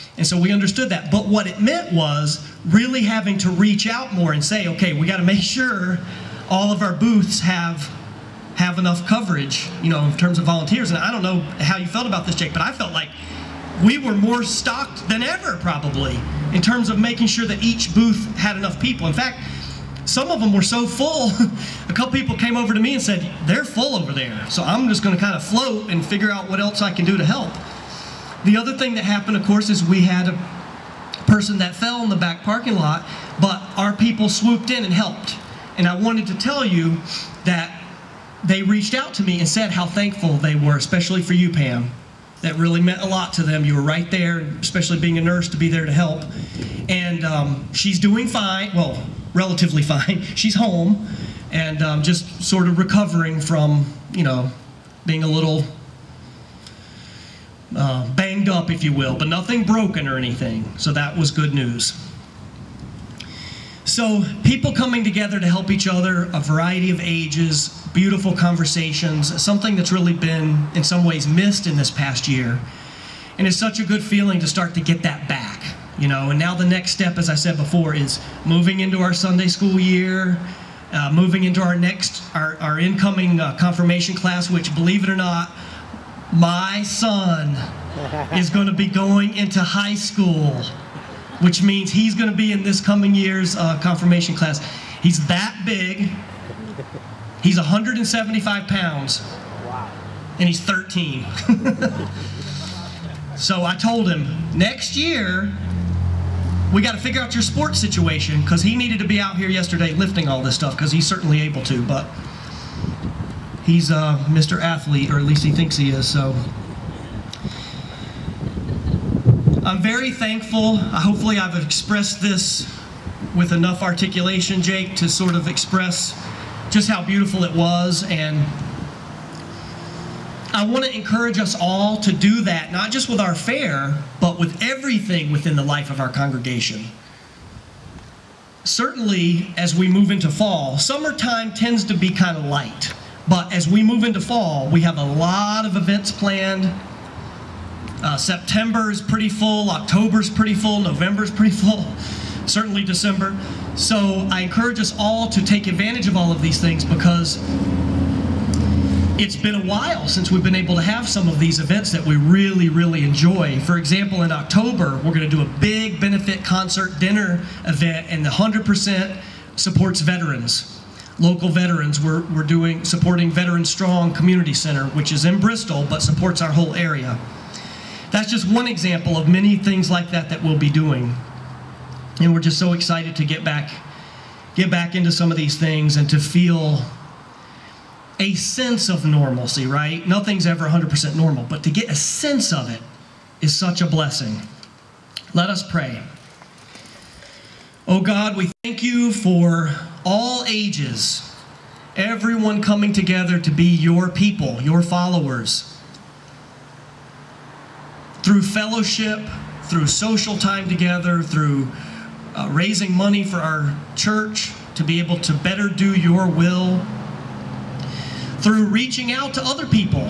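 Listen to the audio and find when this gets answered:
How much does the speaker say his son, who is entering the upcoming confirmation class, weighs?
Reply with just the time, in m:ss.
1:37.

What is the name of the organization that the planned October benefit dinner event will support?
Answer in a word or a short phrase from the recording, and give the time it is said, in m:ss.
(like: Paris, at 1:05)
Veteran Strong Community Center, at 2:53.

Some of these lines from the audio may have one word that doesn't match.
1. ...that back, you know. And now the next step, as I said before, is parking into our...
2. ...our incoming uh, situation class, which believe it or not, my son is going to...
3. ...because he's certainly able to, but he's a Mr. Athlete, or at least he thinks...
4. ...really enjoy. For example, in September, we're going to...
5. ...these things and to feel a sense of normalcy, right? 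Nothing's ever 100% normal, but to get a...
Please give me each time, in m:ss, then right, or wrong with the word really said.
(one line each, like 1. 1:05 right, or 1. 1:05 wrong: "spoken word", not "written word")
1. 1:15 wrong: "moving", not "parking"
2. 1:22 wrong: "confirmation", not "situation"
3. 1:50 right
4. 2:42 wrong: "October", not "September"
5. 3:05 right.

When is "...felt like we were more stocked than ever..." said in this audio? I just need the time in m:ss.
0:12.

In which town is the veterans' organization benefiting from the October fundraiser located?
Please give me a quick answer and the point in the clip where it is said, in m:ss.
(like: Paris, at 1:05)
Bristol, at 2:55.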